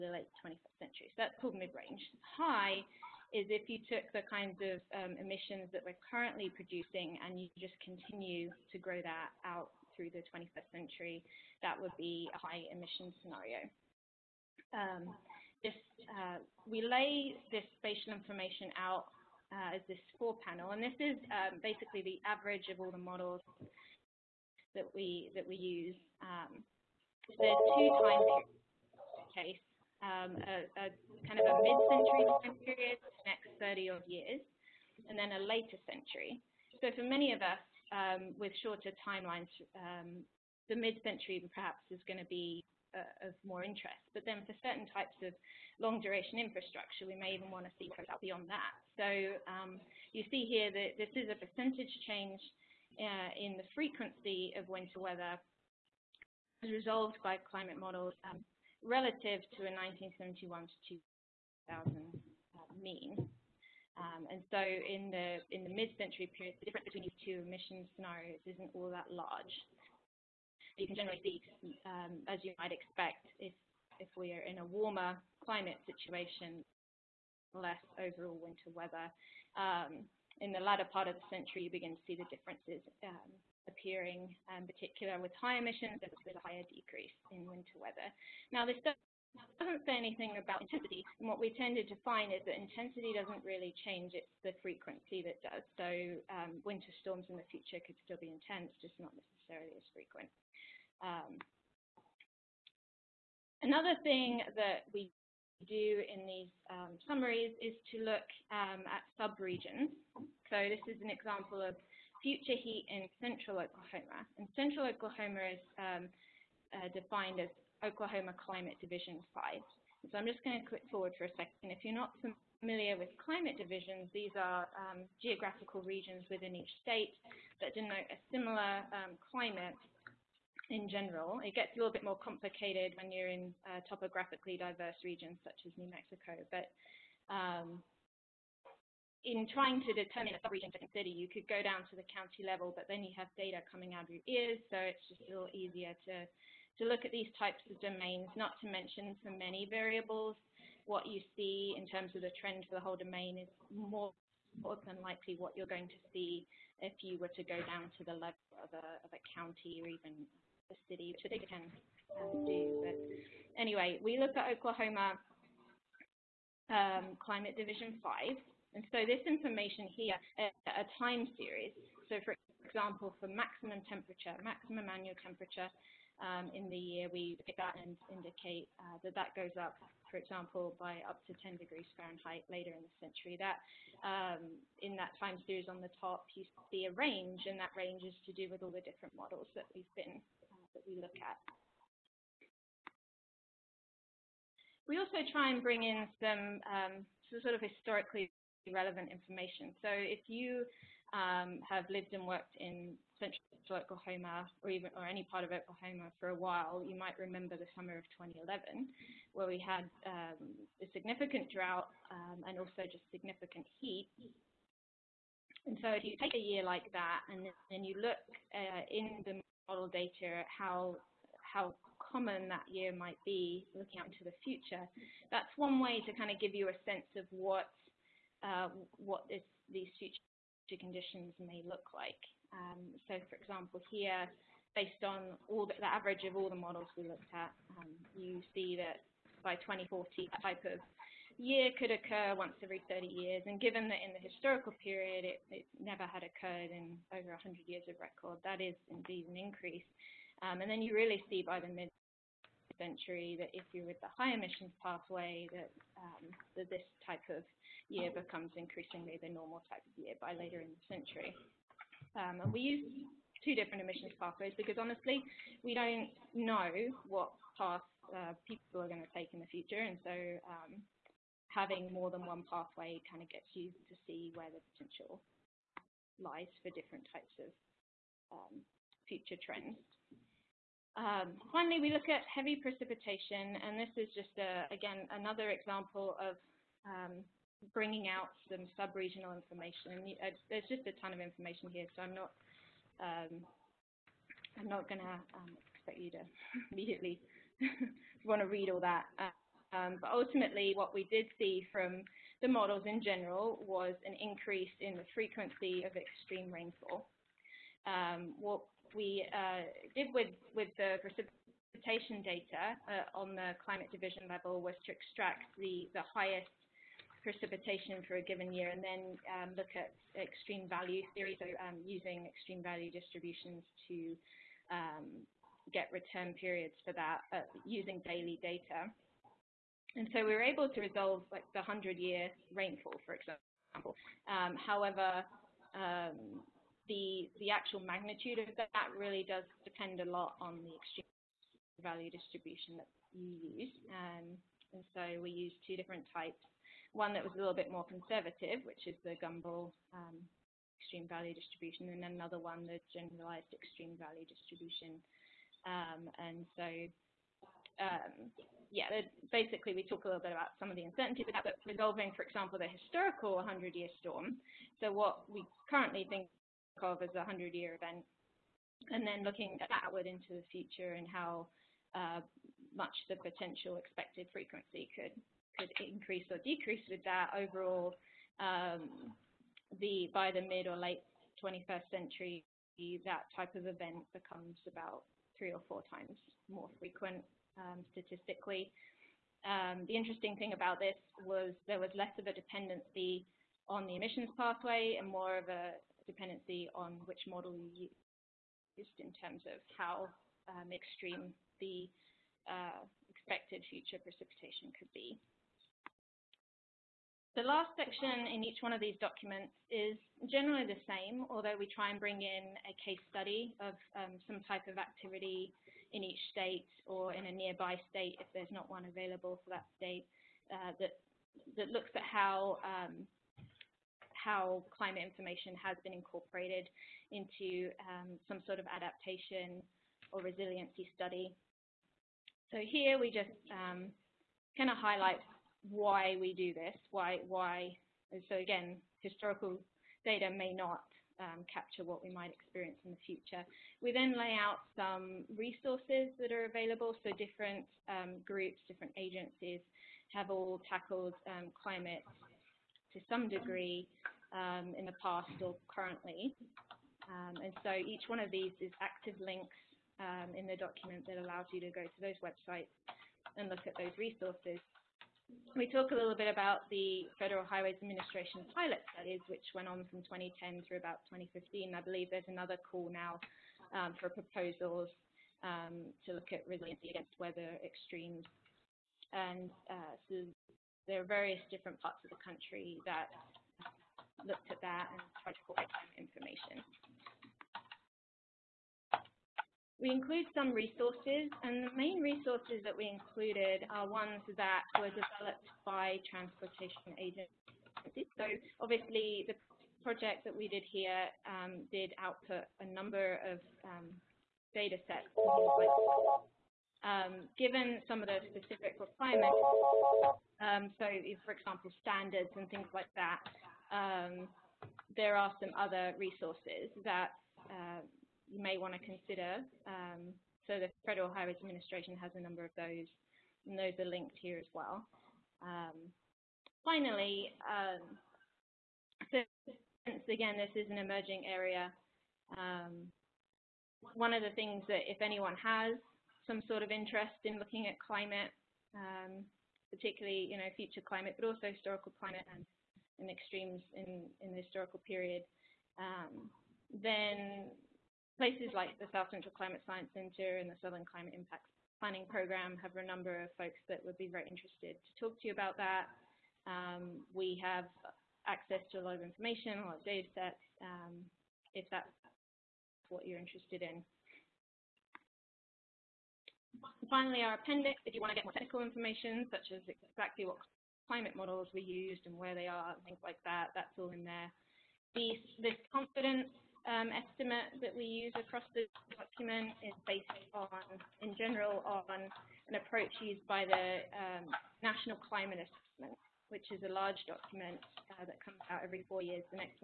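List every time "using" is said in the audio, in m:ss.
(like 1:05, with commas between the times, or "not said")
5:21, 5:27.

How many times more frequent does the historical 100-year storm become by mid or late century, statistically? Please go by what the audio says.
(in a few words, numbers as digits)
3 or 4 times.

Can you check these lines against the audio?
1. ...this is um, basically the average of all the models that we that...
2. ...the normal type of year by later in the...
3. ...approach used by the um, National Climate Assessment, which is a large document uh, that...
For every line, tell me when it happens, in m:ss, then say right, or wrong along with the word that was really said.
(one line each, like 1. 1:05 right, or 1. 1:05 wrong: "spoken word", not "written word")
1. 0:20 right
2. 4:19 right
3. 9:42 right.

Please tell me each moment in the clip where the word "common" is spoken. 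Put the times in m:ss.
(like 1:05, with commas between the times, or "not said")
3:42.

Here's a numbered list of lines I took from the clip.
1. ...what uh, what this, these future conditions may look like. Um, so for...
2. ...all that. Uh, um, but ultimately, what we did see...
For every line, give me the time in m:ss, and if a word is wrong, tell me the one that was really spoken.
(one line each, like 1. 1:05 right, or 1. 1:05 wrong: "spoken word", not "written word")
1. 3:47 right
2. 4:58 right.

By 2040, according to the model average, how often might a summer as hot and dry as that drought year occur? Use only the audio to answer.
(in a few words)
once every 30 years.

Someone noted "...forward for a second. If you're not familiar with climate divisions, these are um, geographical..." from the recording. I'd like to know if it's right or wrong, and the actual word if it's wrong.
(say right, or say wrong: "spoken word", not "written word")
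right.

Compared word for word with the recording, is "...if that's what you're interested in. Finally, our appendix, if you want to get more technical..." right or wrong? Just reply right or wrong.
right.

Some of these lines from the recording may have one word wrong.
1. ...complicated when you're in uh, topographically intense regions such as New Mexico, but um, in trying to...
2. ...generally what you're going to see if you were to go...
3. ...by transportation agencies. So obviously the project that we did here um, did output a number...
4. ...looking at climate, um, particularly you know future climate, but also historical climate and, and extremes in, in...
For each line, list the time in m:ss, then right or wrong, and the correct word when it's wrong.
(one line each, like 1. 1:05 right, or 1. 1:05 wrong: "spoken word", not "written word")
1. 2:12 wrong: "diverse", not "intense"
2. 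2:35 wrong: "likely", not "generally"
3. 8:15 right
4. 8:57 right.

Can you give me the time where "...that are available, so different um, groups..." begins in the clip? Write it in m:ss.
7:26.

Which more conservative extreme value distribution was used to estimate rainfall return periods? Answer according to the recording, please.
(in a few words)
Gumbel.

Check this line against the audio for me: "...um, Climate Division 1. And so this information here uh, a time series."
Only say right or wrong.
wrong.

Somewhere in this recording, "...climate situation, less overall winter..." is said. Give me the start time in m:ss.
1:15.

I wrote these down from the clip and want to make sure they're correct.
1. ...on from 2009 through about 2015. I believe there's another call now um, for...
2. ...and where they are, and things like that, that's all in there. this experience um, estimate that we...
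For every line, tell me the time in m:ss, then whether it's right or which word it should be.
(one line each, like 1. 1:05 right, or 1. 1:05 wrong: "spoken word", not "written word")
1. 7:49 wrong: "2010", not "2009"
2. 9:32 wrong: "confidence", not "experience".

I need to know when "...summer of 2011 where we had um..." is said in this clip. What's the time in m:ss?
3:27.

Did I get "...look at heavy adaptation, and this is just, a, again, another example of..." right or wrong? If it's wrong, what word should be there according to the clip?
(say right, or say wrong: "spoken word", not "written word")
wrong: "precipitation", not "adaptation".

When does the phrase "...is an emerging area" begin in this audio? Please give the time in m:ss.
8:50.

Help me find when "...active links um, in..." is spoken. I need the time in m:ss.
7:38.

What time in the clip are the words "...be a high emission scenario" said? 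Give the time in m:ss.
0:11.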